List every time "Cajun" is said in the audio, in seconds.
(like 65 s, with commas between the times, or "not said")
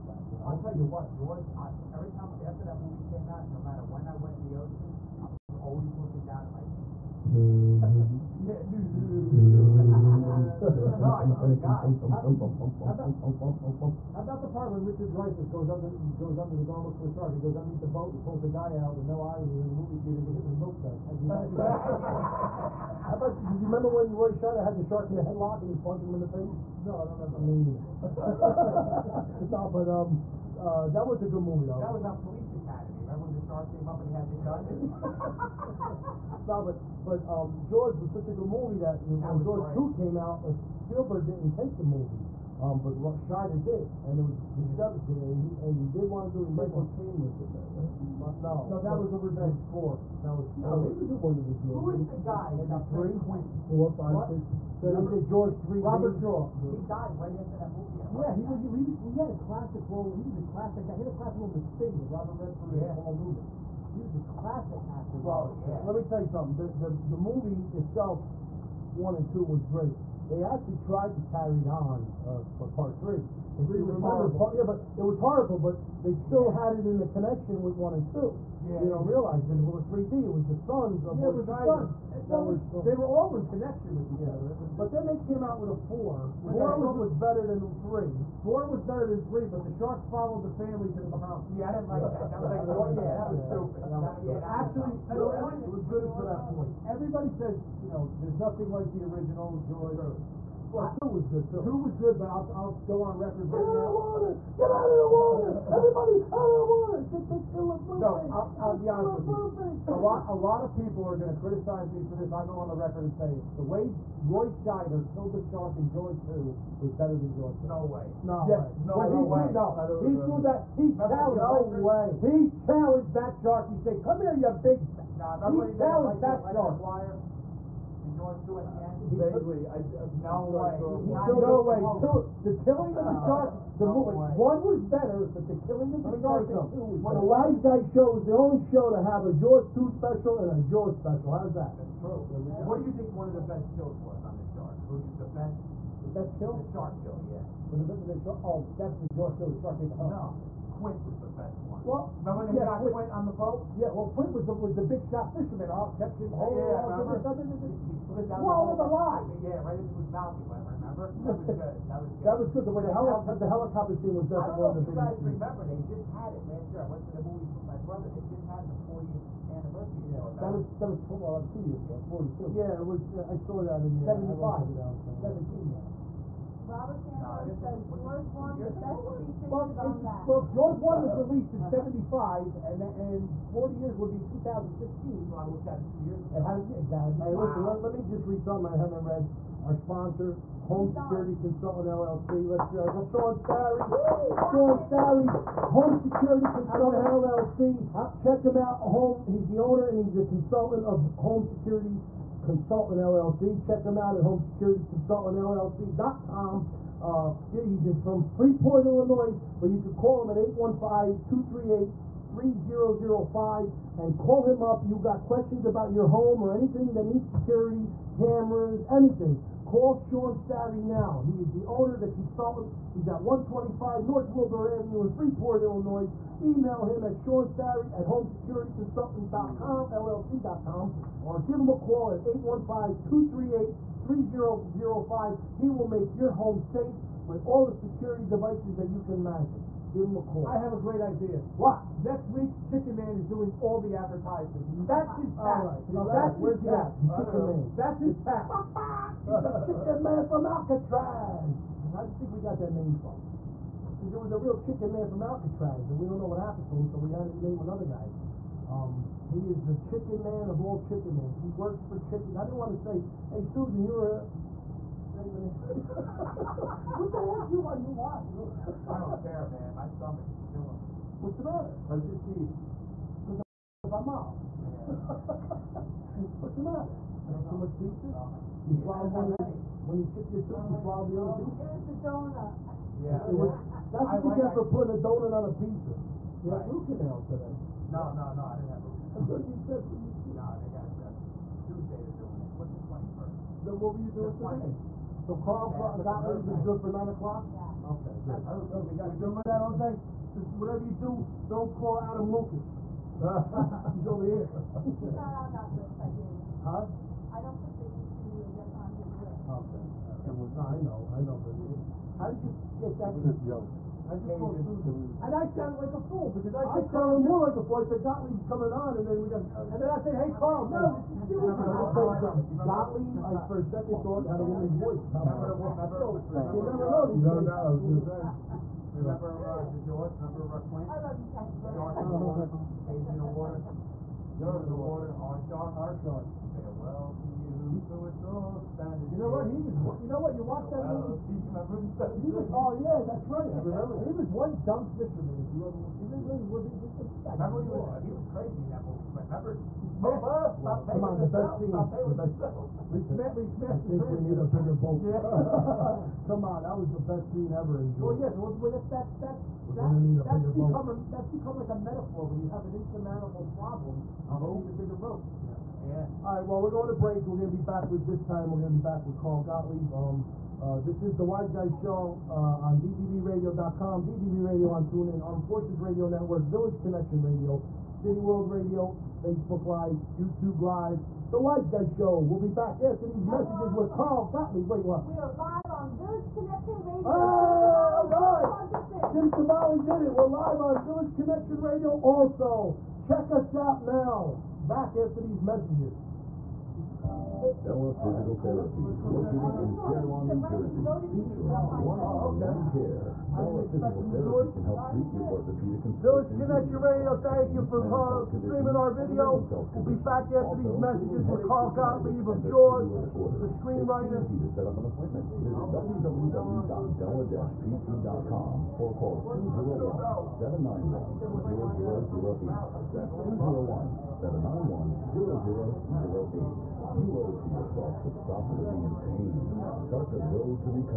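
314 s, 332 s.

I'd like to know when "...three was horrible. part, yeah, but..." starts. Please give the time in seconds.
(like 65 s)
73 s.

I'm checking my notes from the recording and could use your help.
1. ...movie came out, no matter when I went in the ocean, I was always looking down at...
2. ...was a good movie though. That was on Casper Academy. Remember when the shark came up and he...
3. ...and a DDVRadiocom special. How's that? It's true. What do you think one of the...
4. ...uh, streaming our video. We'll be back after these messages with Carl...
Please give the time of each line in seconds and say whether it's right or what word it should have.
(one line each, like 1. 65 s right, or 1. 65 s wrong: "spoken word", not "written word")
1. 2 s right
2. 31 s wrong: "Police", not "Casper"
3. 140 s wrong: "Jaws", not "DDVRadiocom"
4. 407 s right.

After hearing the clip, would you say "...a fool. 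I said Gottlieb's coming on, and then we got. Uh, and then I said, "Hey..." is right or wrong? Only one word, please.
right.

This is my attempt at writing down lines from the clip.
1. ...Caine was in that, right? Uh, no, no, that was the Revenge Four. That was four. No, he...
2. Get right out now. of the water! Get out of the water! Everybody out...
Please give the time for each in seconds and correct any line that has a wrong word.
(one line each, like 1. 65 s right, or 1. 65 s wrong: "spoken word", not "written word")
1. 46 s right
2. 103 s right.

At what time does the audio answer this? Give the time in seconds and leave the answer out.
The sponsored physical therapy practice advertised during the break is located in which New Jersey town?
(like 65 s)
399 s.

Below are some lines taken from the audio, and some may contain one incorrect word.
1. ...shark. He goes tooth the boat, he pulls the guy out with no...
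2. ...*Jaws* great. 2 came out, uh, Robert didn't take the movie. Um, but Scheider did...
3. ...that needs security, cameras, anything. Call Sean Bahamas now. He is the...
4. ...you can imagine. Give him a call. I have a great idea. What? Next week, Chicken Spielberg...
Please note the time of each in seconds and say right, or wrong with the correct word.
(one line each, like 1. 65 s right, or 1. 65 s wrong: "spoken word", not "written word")
1. 17 s wrong: "underneath", not "tooth"
2. 39 s wrong: "Spielberg", not "Robert"
3. 216 s wrong: "Starry", not "Bahamas"
4. 238 s wrong: "Man", not "Spielberg".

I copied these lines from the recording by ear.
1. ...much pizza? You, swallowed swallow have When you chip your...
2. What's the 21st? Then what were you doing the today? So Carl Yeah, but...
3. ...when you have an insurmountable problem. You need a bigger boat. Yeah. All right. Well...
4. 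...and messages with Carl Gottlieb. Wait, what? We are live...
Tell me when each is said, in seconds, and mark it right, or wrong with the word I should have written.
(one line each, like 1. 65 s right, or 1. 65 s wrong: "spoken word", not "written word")
1. 277 s right
2. 292 s right
3. 362 s right
4. 383 s right.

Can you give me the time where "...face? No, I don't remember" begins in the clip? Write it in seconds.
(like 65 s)
26 s.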